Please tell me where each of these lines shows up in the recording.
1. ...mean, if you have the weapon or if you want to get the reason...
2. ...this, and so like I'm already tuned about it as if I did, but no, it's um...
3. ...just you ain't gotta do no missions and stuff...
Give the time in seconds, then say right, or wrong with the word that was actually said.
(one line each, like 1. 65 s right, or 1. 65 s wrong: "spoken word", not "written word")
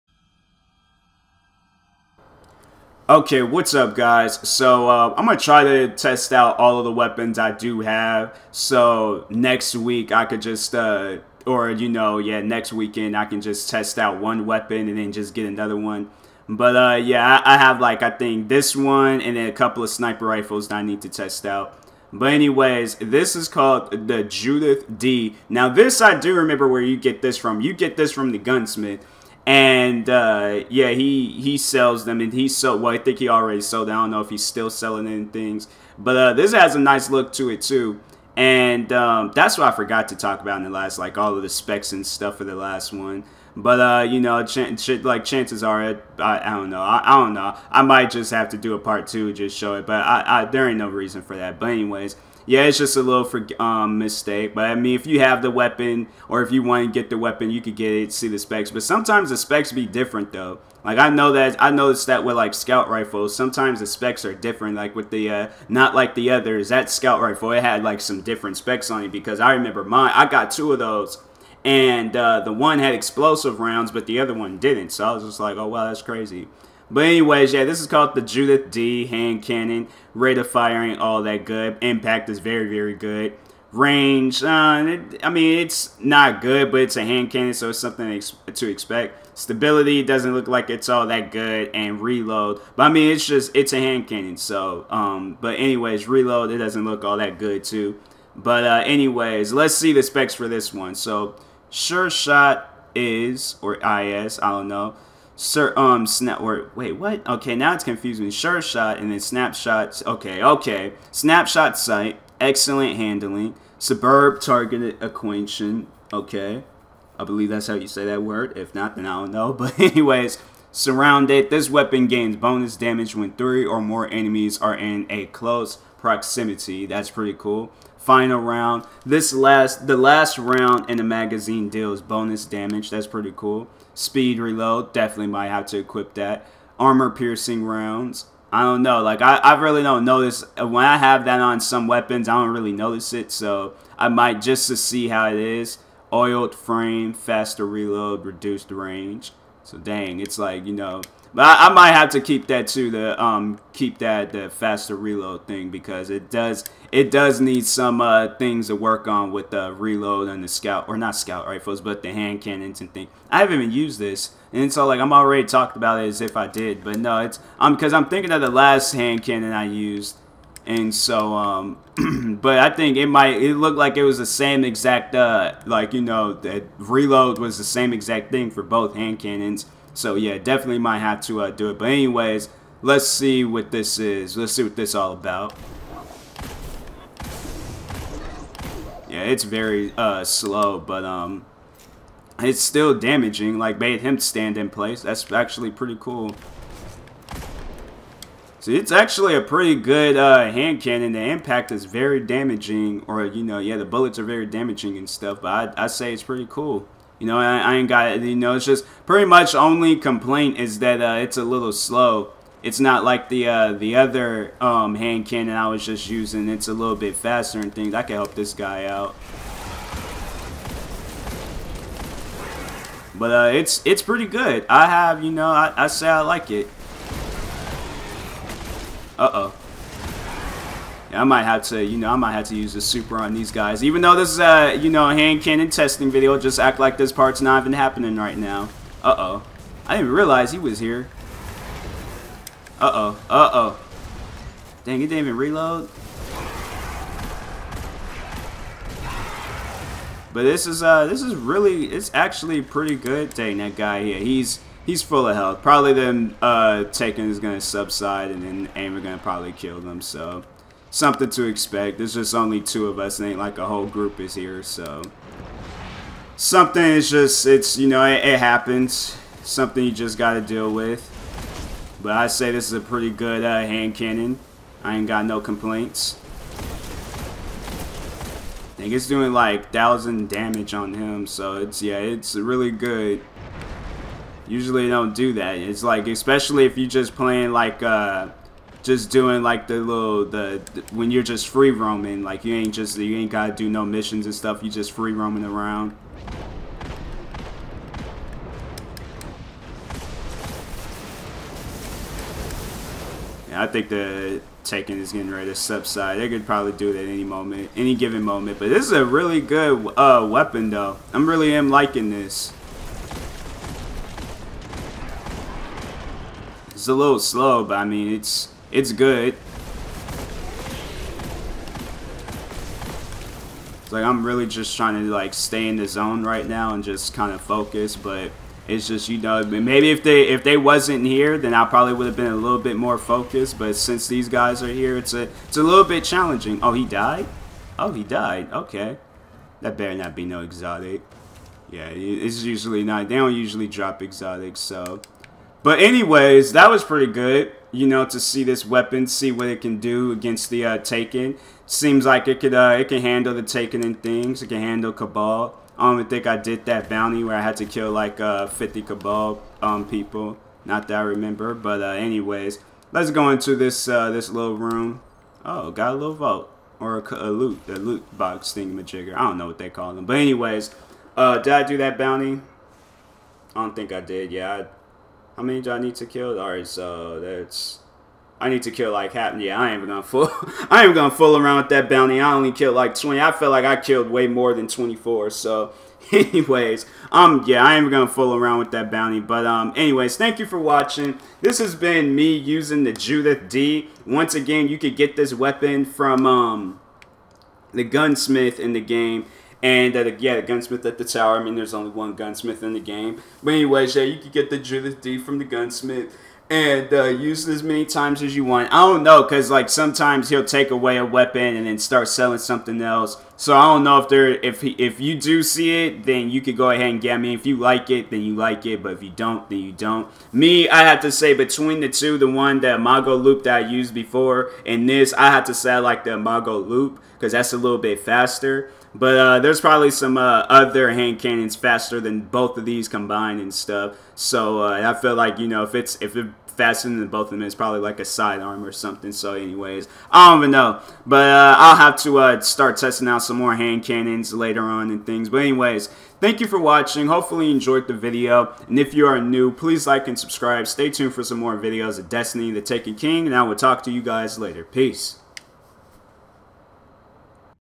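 1. 54 s wrong: "weapon", not "reason"
2. 163 s wrong: "talked", not "tuned"
3. 292 s right.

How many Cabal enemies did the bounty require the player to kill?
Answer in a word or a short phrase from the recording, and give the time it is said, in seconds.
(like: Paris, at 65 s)
50, at 358 s.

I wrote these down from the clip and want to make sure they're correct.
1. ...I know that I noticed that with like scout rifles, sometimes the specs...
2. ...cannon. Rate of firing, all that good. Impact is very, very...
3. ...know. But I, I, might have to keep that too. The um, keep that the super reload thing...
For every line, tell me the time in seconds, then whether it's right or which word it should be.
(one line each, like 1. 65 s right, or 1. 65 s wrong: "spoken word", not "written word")
1. 60 s right
2. 79 s right
3. 150 s wrong: "faster", not "super".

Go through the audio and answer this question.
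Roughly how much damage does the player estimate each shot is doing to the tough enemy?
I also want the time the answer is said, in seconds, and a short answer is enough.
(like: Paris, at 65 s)
1000, at 279 s.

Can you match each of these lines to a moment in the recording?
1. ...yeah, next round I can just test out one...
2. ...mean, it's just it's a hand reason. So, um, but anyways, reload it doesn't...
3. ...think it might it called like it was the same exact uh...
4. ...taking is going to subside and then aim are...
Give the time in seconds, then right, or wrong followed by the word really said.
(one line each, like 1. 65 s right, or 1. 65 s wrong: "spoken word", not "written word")
1. 12 s wrong: "weekend", not "round"
2. 92 s wrong: "cannon", not "reason"
3. 172 s wrong: "looked", not "called"
4. 256 s right.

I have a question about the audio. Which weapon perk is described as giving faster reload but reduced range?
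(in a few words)
Oiled frame.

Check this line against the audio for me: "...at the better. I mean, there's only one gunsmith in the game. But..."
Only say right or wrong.
wrong.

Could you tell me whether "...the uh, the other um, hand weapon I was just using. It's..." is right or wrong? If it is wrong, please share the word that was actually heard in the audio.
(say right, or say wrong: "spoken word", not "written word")
wrong: "cannon", not "weapon".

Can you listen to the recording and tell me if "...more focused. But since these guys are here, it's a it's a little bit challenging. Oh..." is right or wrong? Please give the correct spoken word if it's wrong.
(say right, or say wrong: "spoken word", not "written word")
right.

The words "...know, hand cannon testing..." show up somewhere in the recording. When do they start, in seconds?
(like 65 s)
234 s.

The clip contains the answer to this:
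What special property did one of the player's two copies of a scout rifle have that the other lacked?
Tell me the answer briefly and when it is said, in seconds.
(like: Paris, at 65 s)
explosive rounds, at 72 s.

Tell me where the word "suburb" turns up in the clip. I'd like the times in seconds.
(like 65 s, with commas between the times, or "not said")
113 s.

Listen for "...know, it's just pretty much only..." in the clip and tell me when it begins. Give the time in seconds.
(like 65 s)
208 s.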